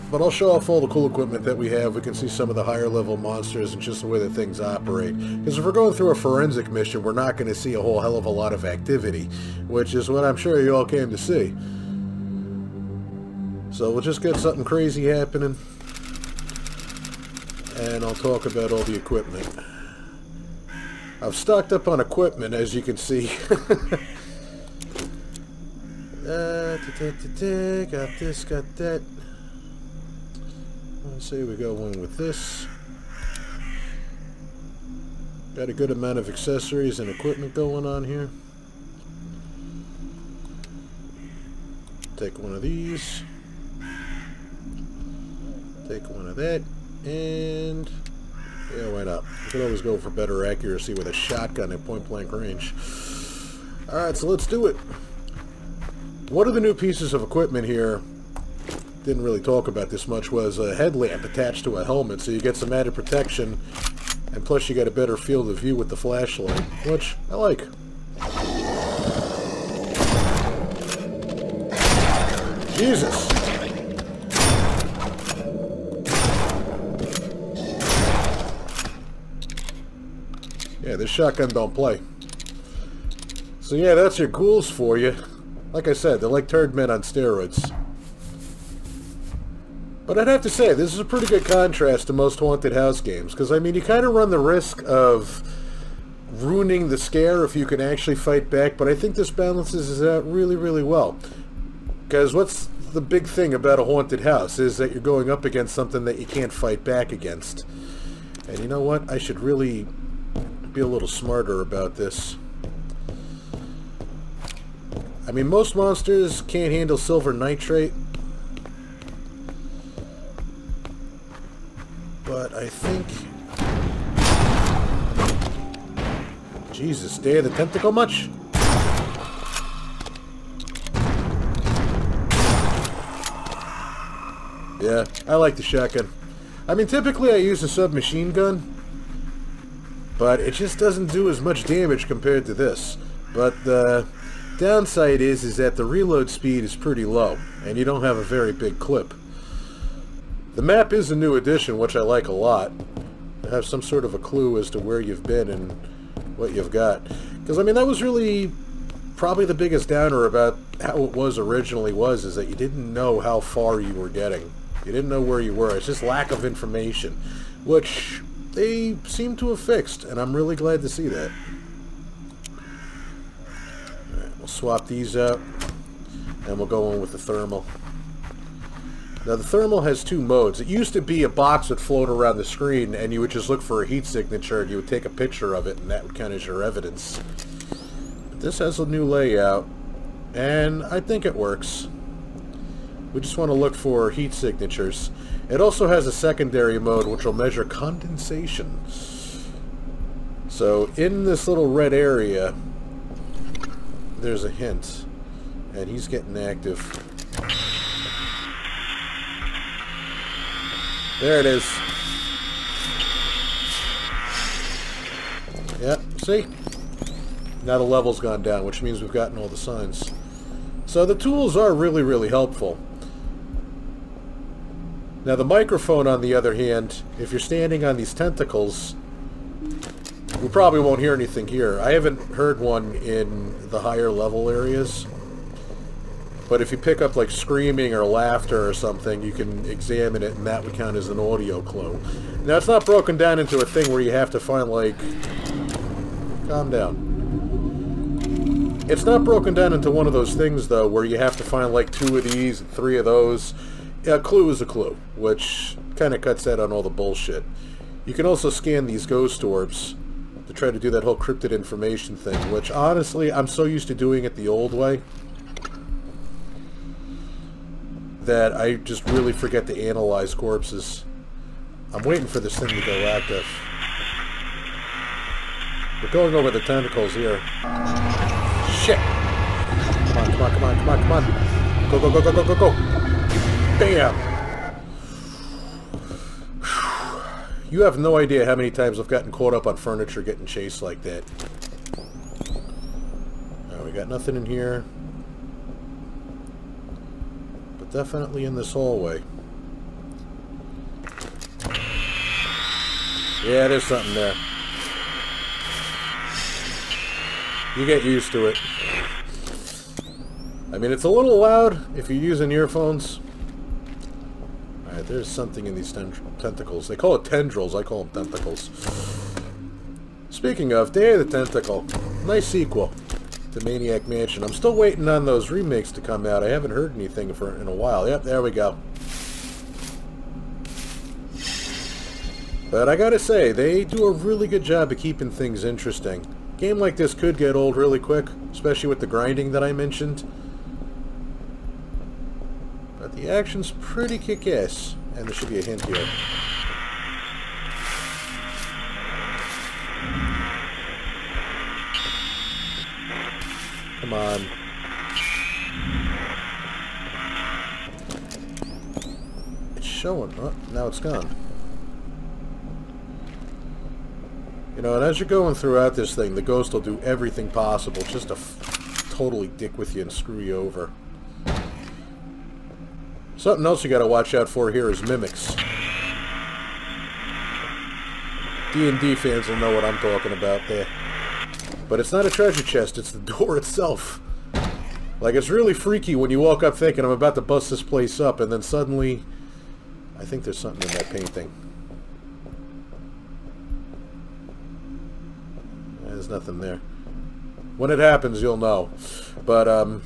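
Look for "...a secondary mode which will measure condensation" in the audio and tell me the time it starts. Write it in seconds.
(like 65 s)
196 s.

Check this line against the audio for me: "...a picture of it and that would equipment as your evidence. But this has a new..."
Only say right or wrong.
wrong.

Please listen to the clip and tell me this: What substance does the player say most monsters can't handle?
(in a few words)
Silver nitrate.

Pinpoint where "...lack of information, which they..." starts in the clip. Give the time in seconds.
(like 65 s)
166 s.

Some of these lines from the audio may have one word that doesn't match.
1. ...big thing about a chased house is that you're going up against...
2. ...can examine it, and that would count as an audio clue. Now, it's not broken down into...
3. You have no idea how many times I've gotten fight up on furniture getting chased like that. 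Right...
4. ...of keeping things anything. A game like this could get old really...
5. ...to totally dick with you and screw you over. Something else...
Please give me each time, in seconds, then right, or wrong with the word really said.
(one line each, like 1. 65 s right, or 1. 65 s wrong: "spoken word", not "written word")
1. 103 s wrong: "haunted", not "chased"
2. 239 s right
3. 287 s wrong: "caught", not "fight"
4. 334 s wrong: "interesting", not "anything"
5. 368 s right.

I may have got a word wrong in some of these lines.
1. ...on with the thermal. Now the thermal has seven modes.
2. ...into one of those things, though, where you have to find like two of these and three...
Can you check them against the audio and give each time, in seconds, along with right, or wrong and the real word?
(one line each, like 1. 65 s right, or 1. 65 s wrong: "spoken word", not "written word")
1. 176 s wrong: "two", not "seven"
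2. 249 s right.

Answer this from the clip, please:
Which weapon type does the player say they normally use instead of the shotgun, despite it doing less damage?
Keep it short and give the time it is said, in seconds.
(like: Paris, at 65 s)
Submachine gun, at 137 s.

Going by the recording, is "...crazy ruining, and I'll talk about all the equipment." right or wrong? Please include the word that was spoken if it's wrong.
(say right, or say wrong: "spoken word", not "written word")
wrong: "happening", not "ruining".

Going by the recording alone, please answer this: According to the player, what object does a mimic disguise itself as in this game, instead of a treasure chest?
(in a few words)
The door.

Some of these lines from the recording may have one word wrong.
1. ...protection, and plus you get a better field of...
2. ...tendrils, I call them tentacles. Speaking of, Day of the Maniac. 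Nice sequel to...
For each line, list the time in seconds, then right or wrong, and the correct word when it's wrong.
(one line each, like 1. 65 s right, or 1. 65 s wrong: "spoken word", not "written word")
1. 62 s right
2. 317 s wrong: "Tentacle", not "Maniac".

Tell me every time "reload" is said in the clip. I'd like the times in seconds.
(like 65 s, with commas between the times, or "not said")
145 s.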